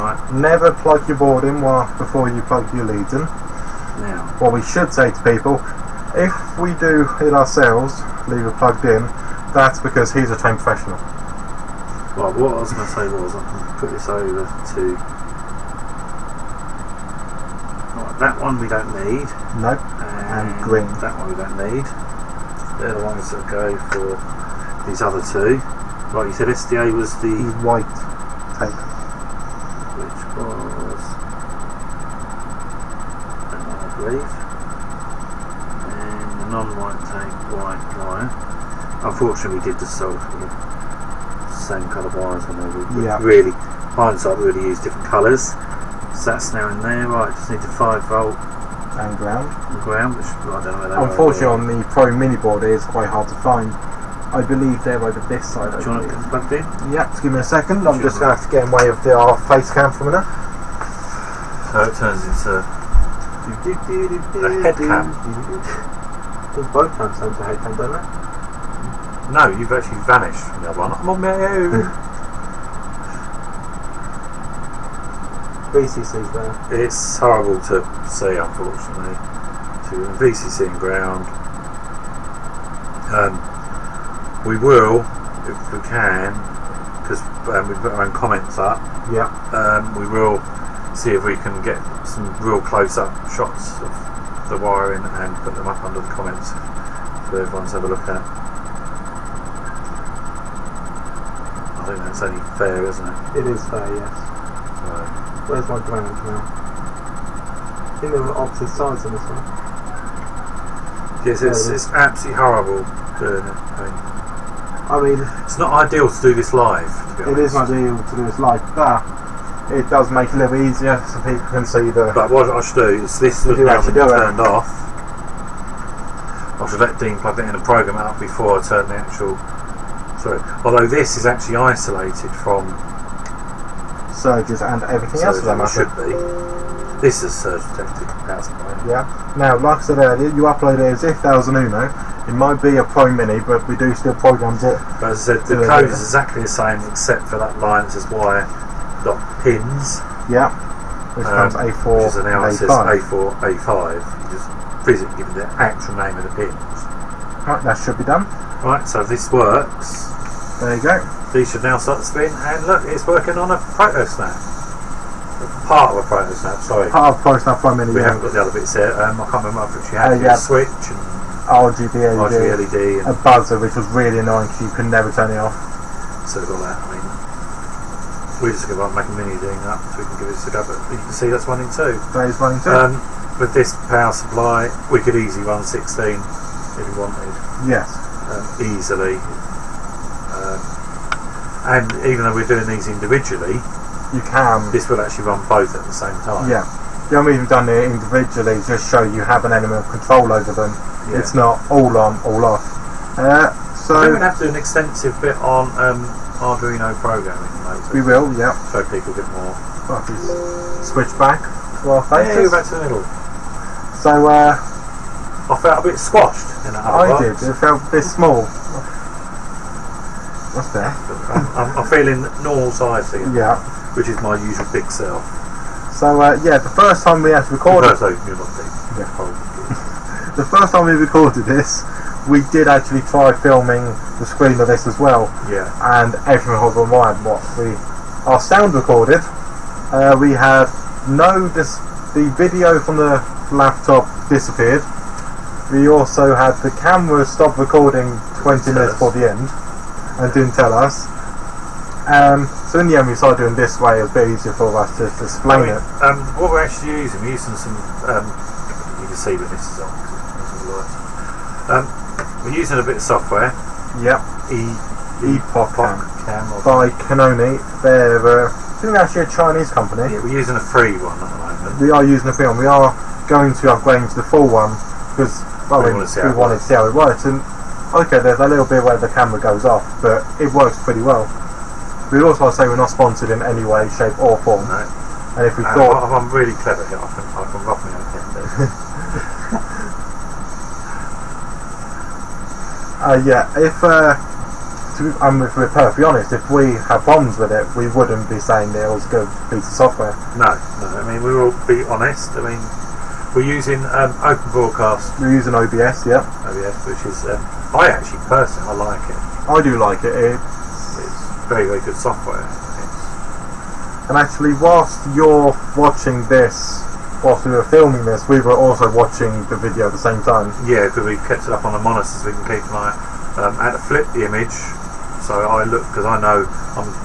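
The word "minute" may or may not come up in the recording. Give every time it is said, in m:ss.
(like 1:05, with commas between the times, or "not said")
1:00, 2:47, 4:08.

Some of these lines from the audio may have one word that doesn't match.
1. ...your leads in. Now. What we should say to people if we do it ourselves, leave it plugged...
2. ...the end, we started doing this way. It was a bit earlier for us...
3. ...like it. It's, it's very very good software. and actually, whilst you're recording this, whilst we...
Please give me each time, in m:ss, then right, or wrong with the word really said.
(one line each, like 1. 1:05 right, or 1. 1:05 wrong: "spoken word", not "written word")
1. 0:02 right
2. 4:12 wrong: "easier", not "earlier"
3. 5:09 wrong: "watching", not "recording".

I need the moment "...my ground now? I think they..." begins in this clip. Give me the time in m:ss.
1:45.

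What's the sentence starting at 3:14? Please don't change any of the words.
This will actually run both at the same time.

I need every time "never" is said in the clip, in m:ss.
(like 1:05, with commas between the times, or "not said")
0:00, 2:54.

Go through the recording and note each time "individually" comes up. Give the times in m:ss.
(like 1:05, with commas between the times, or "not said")
3:12, 3:17.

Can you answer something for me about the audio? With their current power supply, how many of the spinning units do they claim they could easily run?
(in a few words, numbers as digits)
16.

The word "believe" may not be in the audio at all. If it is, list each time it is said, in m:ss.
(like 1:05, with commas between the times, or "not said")
0:33, 0:54.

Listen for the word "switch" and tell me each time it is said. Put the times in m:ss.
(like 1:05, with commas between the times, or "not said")
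2:50, 3:30.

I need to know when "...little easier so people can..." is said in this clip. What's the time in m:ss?
2:00.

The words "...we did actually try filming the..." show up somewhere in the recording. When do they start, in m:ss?
3:52.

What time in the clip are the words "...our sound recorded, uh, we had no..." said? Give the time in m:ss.
3:58.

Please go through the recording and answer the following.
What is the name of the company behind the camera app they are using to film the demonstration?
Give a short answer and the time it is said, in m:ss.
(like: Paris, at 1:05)
Kinoni, at 4:27.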